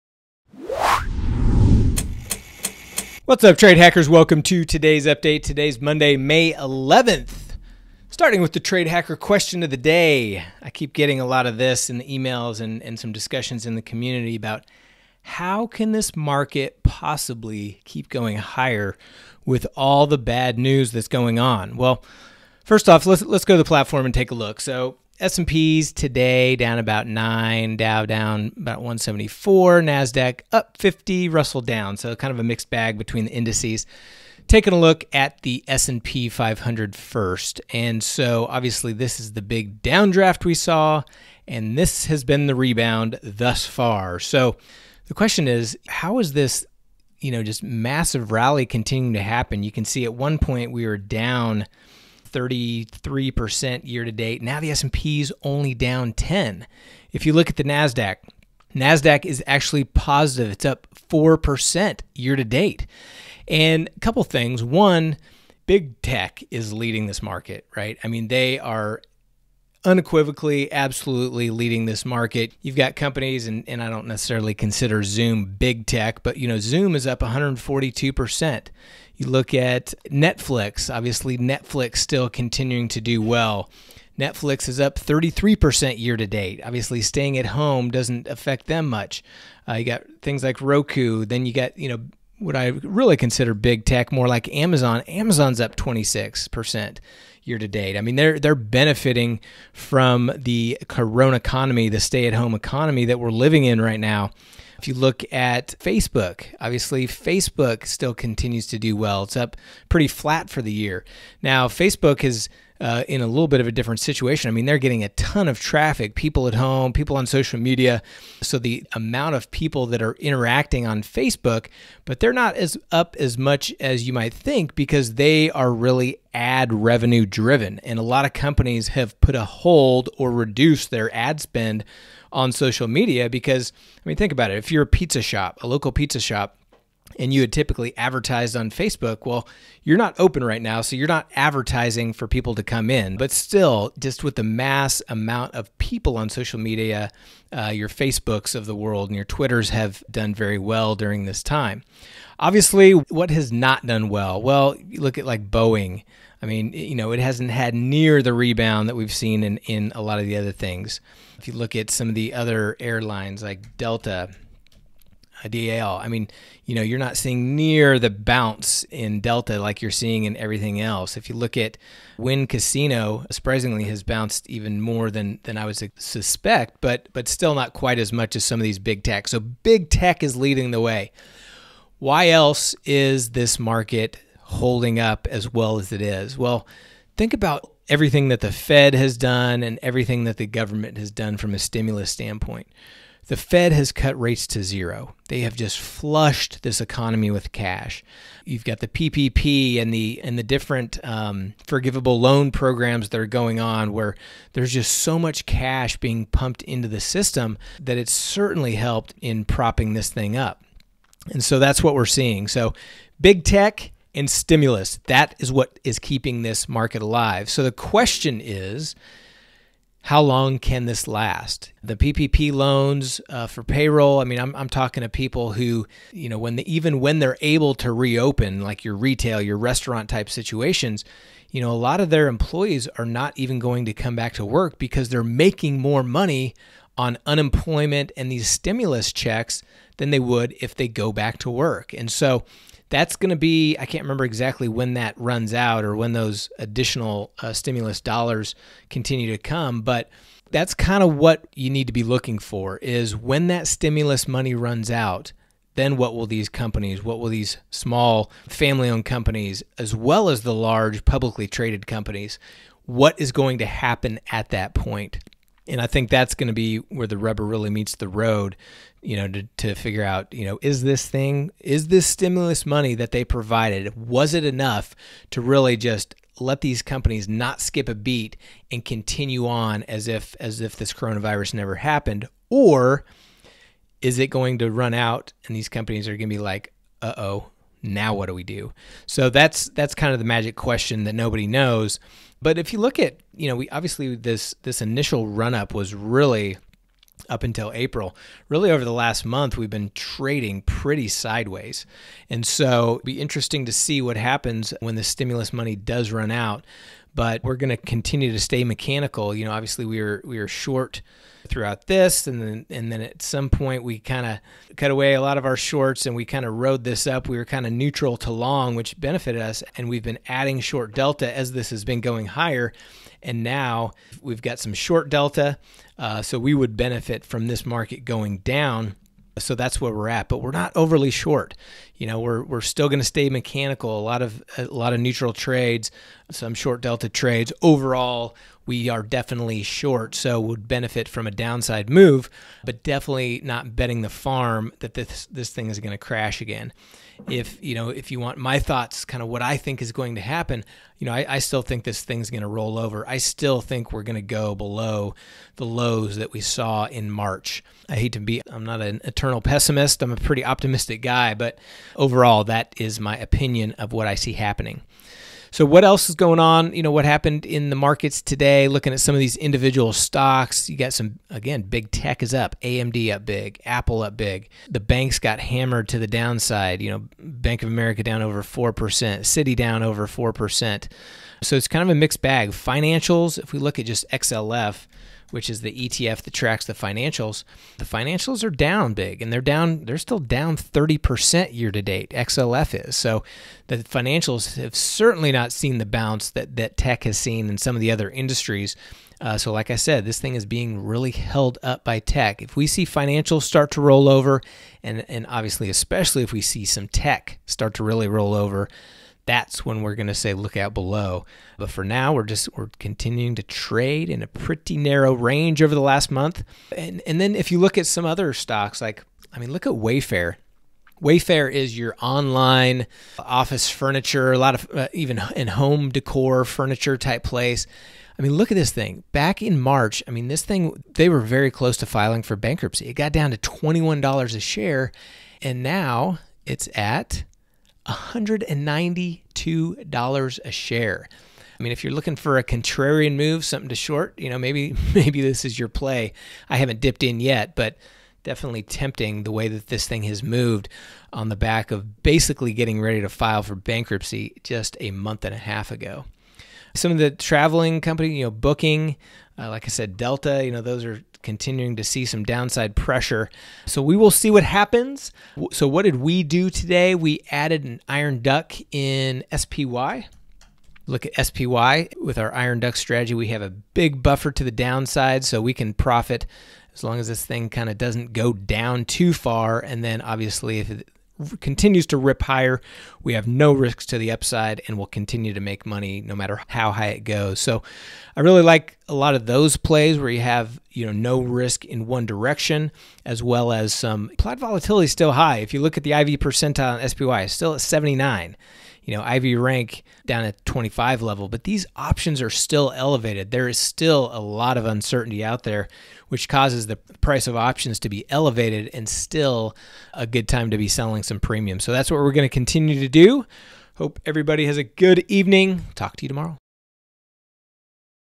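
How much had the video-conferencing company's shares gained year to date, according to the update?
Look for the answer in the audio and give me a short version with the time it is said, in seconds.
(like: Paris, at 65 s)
142%, at 77 s.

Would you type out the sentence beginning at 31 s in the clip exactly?
So kind of a mixed bag between the indices.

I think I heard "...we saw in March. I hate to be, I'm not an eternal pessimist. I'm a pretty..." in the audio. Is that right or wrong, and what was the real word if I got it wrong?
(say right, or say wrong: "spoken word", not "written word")
right.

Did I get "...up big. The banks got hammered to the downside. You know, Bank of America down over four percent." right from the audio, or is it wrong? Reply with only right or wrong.
right.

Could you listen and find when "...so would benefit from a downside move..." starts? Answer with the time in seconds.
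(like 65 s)
340 s.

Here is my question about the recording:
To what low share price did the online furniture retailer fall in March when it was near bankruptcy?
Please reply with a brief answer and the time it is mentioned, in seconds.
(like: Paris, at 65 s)
$21, at 433 s.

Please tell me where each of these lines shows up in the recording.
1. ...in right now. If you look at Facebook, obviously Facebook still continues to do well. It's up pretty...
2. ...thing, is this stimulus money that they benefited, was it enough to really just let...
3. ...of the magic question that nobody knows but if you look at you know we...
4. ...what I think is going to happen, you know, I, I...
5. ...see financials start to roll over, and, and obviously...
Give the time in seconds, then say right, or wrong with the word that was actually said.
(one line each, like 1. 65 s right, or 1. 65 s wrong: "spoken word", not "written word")
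1. 103 s right
2. 271 s wrong: "provided", not "benefited"
3. 290 s right
4. 349 s right
5. 402 s right.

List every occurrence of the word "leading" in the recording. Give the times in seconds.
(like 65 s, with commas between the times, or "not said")
66 s, 71 s, 180 s.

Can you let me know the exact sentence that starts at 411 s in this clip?
But for now, we're just we're continuing to trade in a pretty narrow range over the last month.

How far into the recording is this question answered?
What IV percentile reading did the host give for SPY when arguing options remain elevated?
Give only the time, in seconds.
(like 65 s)
497 s.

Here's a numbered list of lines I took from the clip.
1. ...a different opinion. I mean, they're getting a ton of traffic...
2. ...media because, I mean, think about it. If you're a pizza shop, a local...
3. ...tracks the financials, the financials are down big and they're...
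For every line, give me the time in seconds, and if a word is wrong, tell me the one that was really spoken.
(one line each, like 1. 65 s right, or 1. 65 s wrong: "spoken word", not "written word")
1. 113 s wrong: "situation", not "opinion"
2. 132 s right
3. 386 s right.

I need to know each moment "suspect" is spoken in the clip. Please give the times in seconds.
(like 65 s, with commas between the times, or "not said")
176 s.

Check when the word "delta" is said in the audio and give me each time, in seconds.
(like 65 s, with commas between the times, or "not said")
163 s, 169 s, 320 s, 325 s, 336 s, 459 s.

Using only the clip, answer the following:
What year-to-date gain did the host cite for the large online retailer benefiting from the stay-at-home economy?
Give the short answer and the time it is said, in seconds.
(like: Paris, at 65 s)
26%, at 95 s.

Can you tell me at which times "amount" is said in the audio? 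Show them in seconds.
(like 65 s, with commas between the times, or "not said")
118 s, 145 s.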